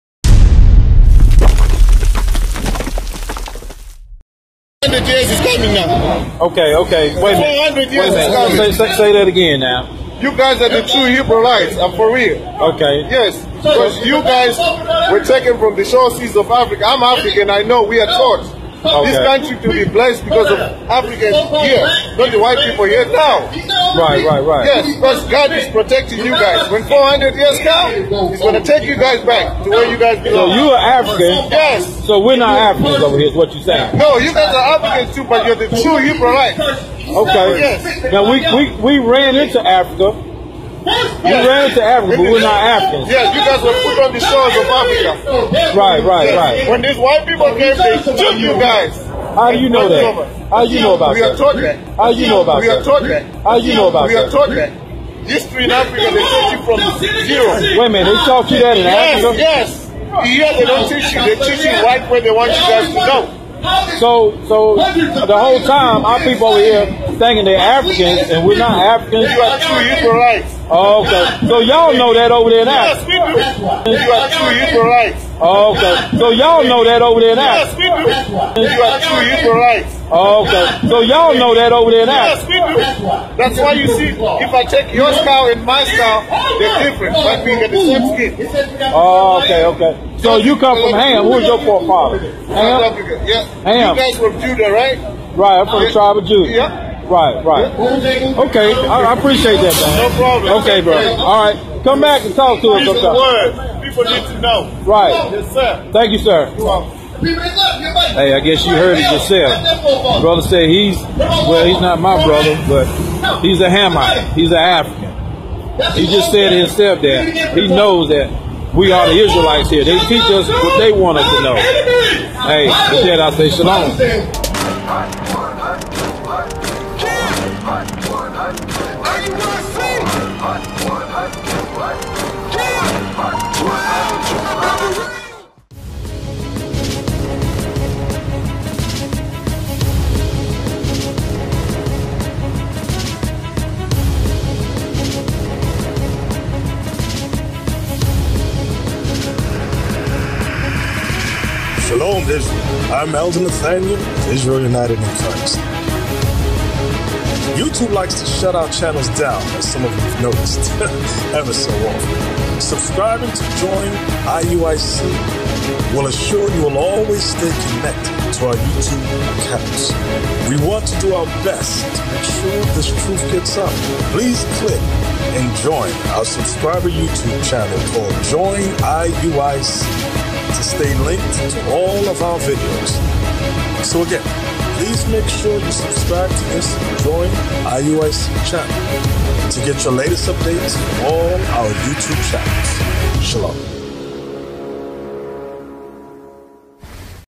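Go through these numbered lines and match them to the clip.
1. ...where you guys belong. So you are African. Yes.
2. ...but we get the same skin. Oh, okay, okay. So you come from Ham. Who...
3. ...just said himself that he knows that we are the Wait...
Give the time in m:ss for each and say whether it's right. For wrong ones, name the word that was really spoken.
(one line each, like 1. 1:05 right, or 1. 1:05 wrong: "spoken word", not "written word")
1. 0:29 right
2. 1:27 right
3. 1:56 wrong: "Israelites", not "Wait".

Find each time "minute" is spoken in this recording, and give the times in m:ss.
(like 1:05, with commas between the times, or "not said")
0:07, 0:57.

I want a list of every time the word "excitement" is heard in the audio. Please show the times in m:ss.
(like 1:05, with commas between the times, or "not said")
not said.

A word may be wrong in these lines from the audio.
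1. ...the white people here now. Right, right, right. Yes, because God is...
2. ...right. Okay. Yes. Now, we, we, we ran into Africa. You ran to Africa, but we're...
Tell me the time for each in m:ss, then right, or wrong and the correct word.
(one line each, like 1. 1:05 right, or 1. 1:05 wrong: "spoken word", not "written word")
1. 0:22 right
2. 0:36 right.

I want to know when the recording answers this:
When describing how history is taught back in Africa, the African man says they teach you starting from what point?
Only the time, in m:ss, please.
0:57.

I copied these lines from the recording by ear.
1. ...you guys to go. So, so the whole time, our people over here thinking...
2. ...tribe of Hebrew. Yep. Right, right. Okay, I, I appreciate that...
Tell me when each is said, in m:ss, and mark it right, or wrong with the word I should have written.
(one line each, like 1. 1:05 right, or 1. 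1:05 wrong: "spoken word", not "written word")
1. 1:02 right
2. 1:35 wrong: "Judah", not "Hebrew".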